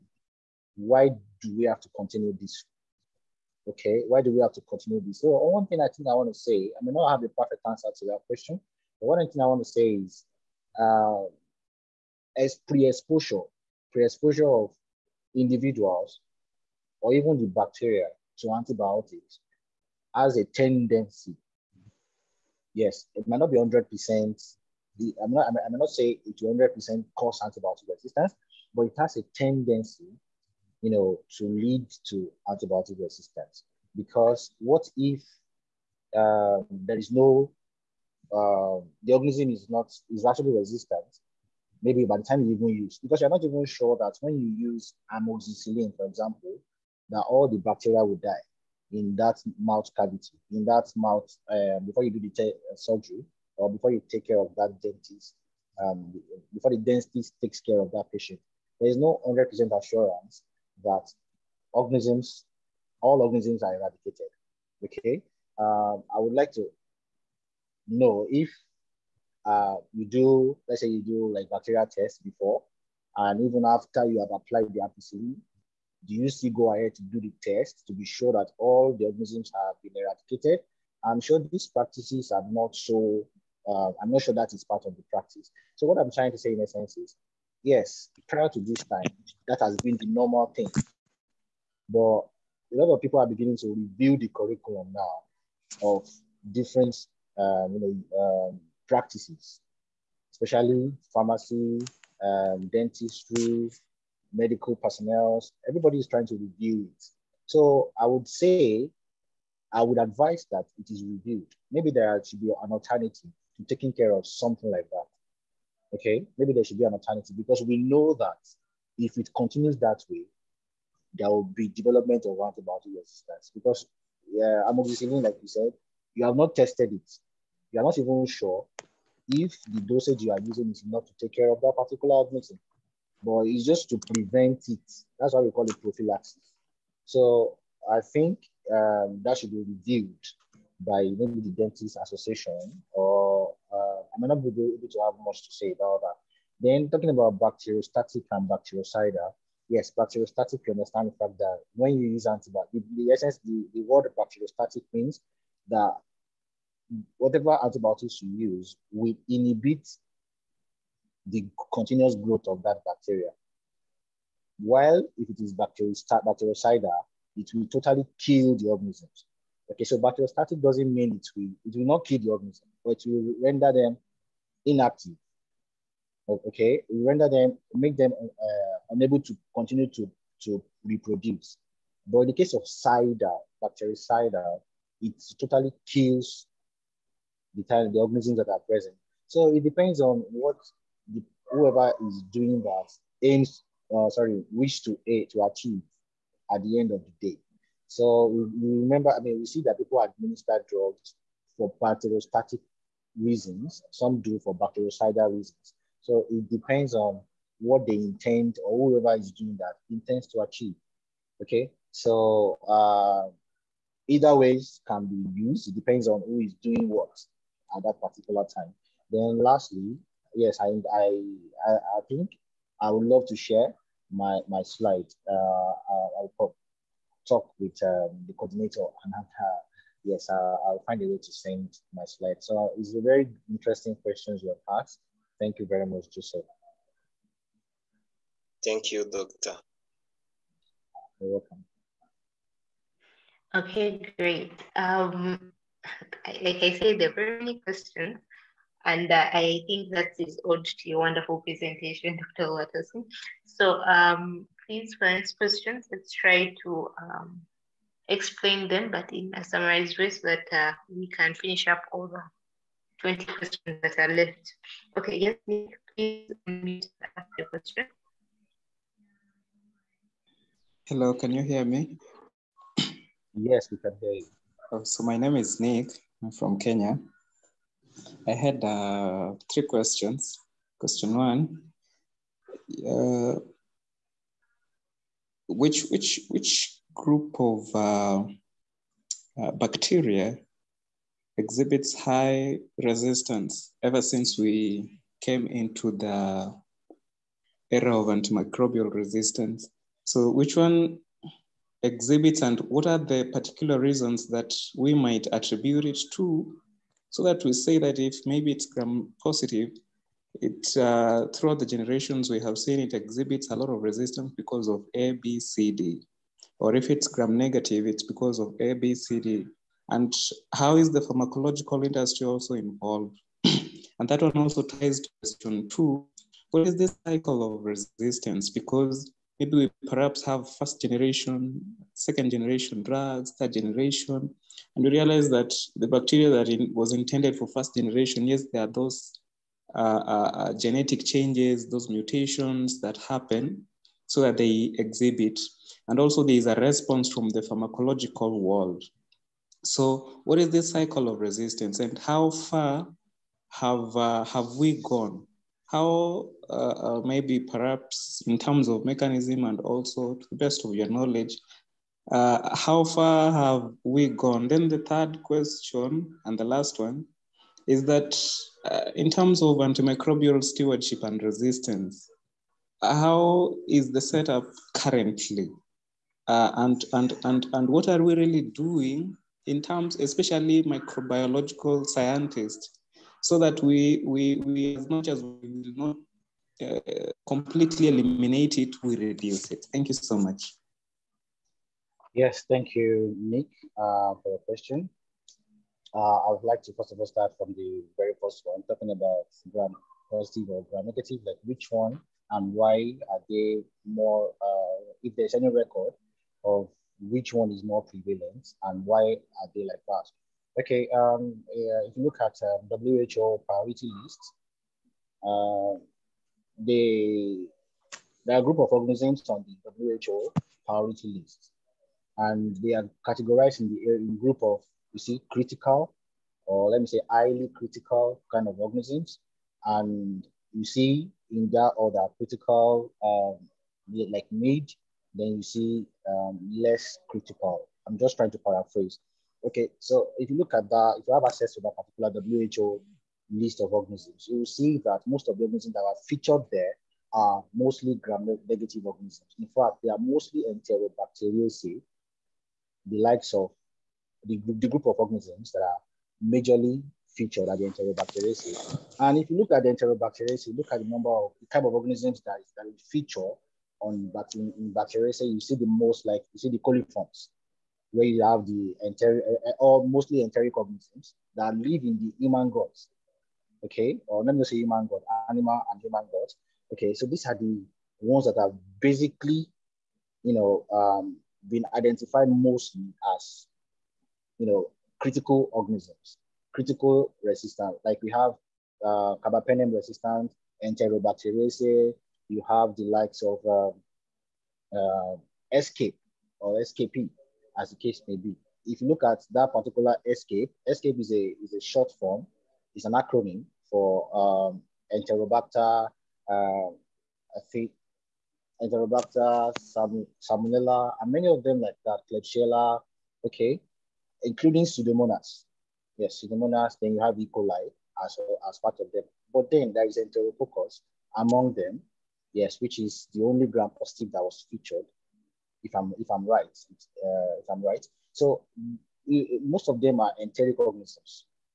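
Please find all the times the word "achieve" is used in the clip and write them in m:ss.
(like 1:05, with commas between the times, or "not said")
3:15, 3:30.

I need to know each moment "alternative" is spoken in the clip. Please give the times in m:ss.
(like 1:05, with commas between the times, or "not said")
1:52, 1:56.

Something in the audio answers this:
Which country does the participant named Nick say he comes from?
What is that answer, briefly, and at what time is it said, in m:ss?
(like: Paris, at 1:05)
Kenya, at 4:36.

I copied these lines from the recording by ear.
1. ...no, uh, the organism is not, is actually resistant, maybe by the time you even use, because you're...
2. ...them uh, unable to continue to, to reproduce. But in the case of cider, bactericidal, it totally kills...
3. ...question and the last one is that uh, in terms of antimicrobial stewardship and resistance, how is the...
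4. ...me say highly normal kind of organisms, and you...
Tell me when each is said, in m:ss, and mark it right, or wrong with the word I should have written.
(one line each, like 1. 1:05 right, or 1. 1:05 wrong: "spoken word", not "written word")
1. 0:37 right
2. 2:57 right
3. 6:05 right
4. 7:06 wrong: "critical", not "normal".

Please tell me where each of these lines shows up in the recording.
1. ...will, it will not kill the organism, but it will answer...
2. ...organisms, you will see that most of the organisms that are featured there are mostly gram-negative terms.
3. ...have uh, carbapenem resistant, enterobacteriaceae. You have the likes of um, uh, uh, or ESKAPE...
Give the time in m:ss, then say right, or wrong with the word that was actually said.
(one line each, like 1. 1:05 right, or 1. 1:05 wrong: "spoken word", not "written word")
1. 2:51 wrong: "render", not "answer"
2. 7:23 wrong: "organisms", not "terms"
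3. 8:08 right.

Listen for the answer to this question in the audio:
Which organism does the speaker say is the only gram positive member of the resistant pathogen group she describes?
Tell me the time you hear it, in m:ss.
8:39.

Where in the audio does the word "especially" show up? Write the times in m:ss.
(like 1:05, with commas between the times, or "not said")
1:40, 6:19.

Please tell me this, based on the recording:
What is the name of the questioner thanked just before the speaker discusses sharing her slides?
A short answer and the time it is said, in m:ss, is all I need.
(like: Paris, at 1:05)
Joseph, at 3:56.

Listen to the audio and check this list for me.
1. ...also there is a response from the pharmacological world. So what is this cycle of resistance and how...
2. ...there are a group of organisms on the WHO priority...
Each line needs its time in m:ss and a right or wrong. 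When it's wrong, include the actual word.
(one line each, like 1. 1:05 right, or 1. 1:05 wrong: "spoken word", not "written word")
1. 5:45 right
2. 6:58 right.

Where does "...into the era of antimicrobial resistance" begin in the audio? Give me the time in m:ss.
4:55.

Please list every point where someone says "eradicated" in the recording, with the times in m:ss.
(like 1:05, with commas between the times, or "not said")
1:03, 1:19.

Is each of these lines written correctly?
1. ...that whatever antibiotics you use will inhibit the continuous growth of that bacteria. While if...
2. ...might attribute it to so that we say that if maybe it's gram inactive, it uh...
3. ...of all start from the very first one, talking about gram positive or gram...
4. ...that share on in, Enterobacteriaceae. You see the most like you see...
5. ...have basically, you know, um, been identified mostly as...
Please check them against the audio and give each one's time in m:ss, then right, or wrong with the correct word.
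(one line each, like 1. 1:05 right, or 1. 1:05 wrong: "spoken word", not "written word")
1. 2:35 right
2. 5:04 wrong: "positive", not "inactive"
3. 6:36 right
4. 7:42 wrong: "feature", not "share"
5. 7:58 right.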